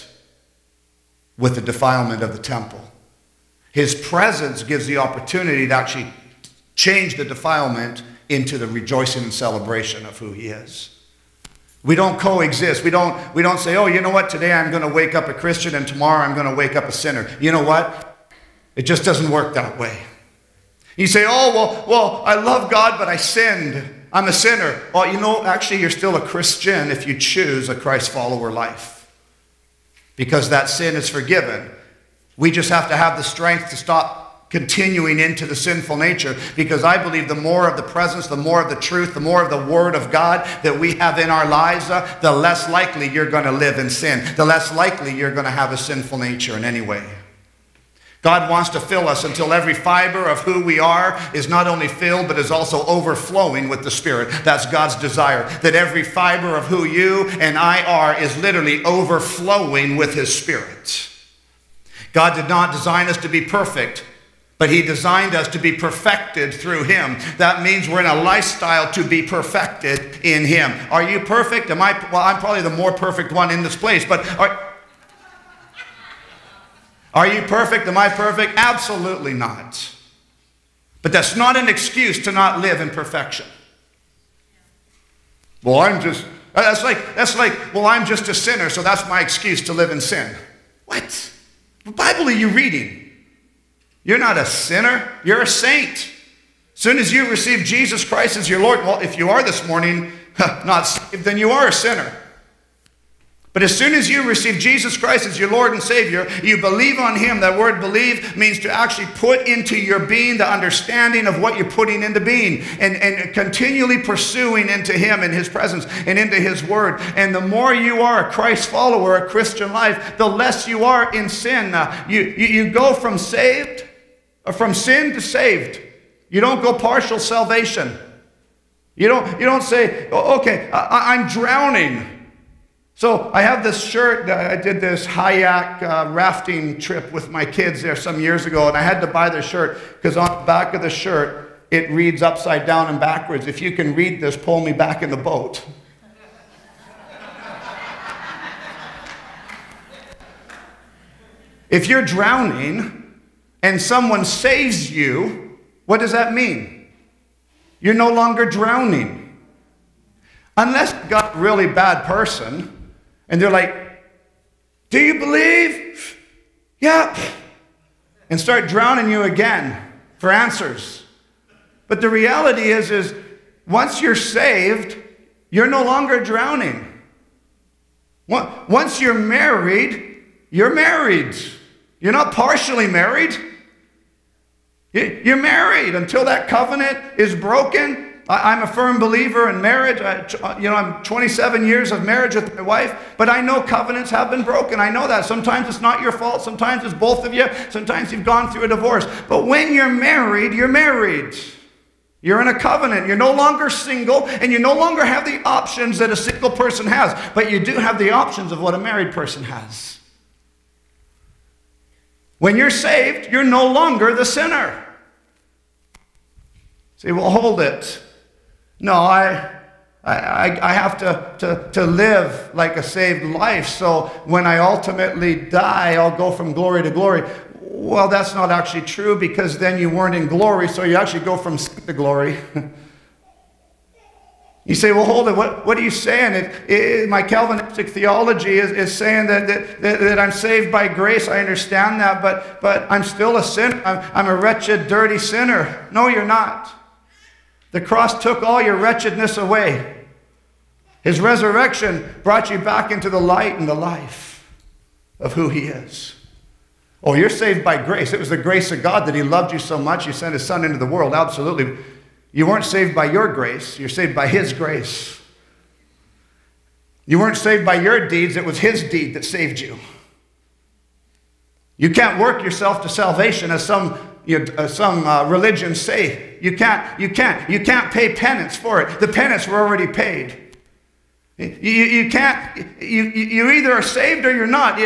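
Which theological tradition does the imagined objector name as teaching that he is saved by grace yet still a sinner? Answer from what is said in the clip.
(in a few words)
Calvinistic.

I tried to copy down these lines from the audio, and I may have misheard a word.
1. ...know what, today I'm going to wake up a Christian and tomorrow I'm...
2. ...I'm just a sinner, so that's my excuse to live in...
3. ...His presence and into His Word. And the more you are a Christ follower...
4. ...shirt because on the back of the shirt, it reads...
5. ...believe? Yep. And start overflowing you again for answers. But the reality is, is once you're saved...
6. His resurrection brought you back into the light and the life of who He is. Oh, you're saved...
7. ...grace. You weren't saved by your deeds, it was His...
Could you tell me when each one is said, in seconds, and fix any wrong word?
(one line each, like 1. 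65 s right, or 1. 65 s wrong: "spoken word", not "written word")
1. 14 s right
2. 87 s right
3. 115 s right
4. 139 s right
5. 165 s wrong: "drowning", not "overflowing"
6. 251 s right
7. 264 s right.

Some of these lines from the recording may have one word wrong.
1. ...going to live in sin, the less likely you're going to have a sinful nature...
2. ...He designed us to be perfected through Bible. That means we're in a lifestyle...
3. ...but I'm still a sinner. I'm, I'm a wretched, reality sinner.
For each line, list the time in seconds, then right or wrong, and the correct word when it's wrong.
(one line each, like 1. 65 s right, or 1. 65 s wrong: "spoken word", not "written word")
1. 43 s right
2. 64 s wrong: "Him", not "Bible"
3. 242 s wrong: "dirty", not "reality".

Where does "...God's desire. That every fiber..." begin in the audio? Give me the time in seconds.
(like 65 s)
54 s.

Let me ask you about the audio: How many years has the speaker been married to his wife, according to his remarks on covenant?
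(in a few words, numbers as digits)
27.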